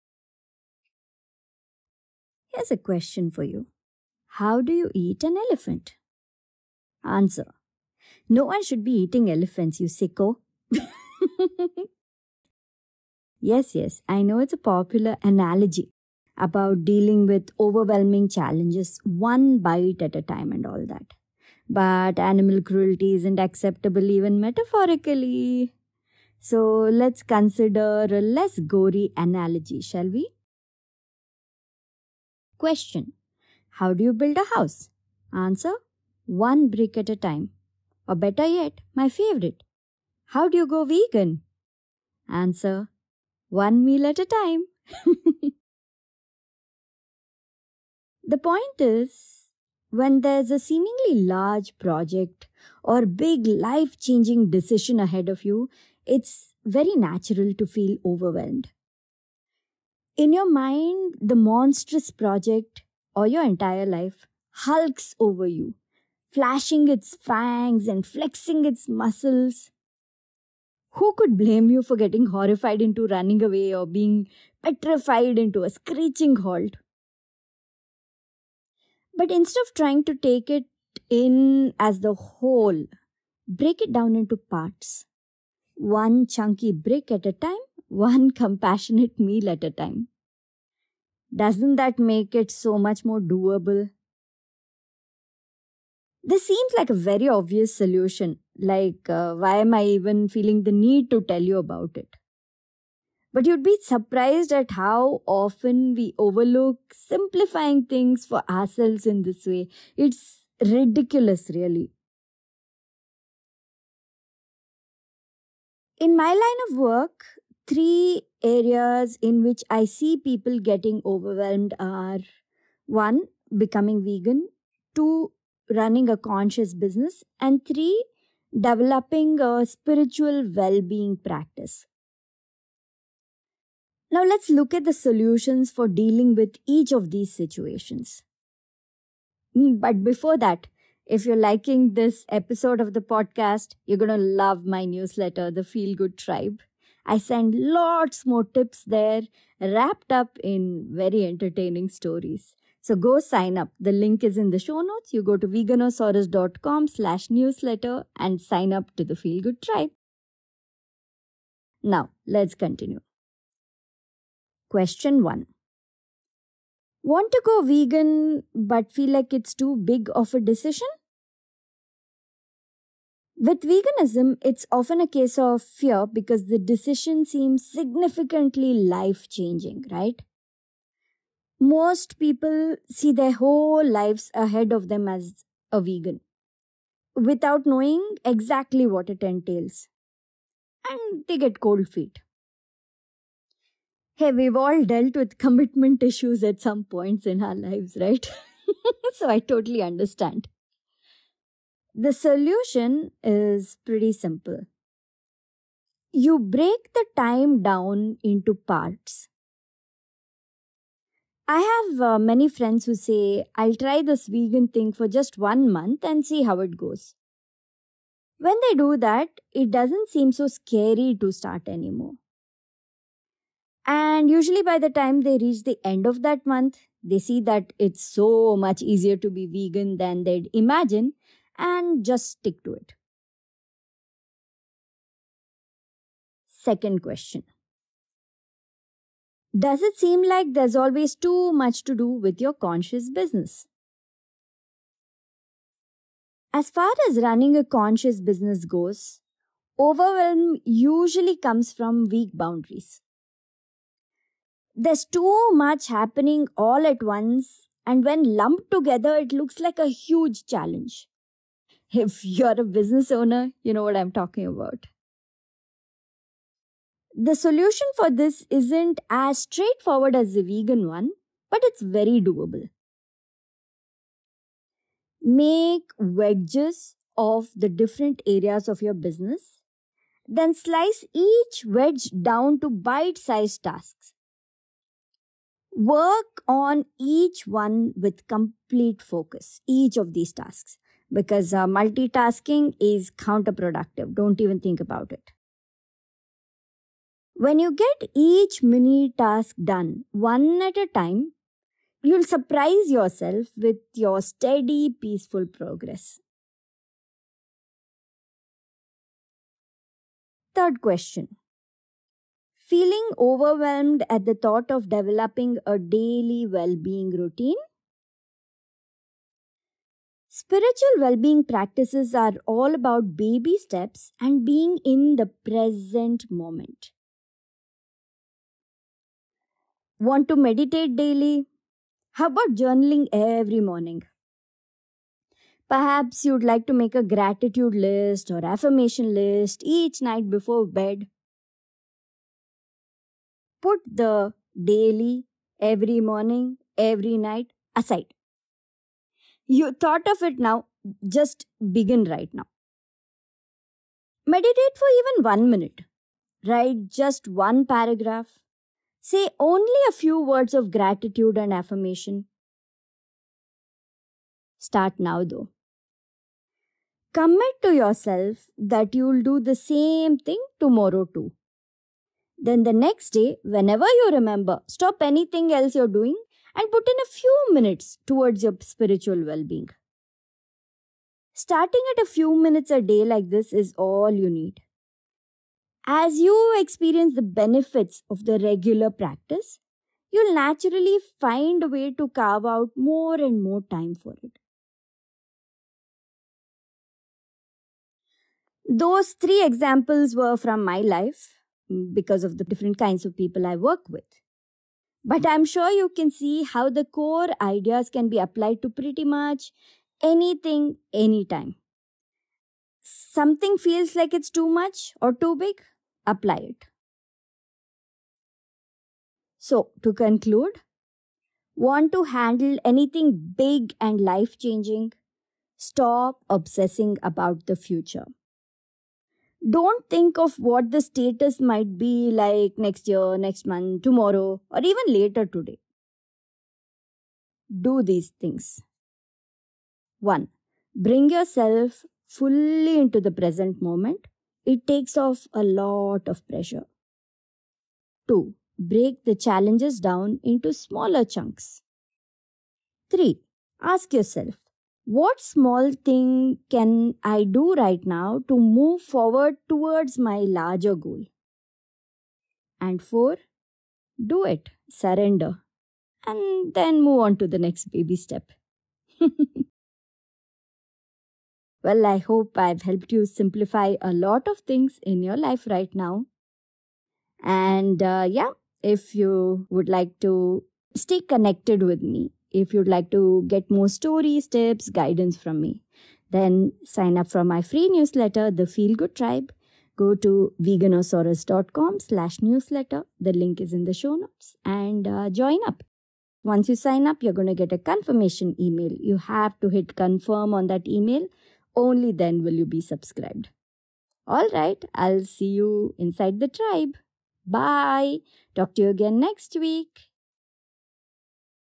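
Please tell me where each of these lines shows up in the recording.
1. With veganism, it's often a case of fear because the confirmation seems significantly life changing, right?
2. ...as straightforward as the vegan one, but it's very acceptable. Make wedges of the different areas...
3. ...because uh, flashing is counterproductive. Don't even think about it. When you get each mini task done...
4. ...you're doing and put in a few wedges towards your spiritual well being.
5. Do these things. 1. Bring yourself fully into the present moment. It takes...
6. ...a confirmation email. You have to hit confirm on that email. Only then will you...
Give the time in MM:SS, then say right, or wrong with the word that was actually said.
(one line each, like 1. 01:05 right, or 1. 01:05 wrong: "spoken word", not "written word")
1. 02:53 wrong: "decision", not "confirmation"
2. 04:29 wrong: "doable", not "acceptable"
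3. 04:51 wrong: "multitasking", not "flashing"
4. 06:15 wrong: "minutes", not "wedges"
5. 07:17 right
6. 08:17 right.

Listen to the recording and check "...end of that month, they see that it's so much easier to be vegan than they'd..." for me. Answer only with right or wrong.
right.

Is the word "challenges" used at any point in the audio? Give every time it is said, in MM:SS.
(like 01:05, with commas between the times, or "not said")
00:18, 04:20, 07:29.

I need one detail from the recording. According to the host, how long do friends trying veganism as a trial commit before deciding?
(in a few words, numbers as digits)
One month.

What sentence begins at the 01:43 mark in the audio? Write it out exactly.
But you'd be surprised at how often we overlook simplifying things for ourselves in this way.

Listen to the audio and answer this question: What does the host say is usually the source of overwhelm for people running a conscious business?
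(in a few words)
Weak boundaries.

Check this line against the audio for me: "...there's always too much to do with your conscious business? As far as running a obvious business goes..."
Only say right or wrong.
wrong.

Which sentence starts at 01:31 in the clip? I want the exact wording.
Doesn't that make it so much more doable?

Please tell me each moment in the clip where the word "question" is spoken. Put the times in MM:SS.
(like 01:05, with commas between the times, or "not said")
00:02, 00:32, 02:44, 03:57, 05:10.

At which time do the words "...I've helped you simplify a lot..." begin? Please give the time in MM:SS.
07:52.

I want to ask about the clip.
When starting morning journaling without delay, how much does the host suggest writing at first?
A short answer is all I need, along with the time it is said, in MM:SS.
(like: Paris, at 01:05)
One paragraph, at 05:57.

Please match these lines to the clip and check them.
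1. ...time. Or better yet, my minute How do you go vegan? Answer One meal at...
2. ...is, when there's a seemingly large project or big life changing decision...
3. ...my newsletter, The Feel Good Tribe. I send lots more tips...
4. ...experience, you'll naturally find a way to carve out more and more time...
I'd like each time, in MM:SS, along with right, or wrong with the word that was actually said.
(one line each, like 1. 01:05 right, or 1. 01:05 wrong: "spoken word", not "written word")
1. 00:37 wrong: "favorite", not "minute"
2. 00:48 right
3. 02:24 right
4. 06:28 wrong: "practice", not "experience".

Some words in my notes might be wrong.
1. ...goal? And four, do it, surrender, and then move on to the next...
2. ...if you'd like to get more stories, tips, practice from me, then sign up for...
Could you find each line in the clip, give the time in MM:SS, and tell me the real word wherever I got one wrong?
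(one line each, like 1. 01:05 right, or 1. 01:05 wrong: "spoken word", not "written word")
1. 07:40 right
2. 08:02 wrong: "guidance", not "practice".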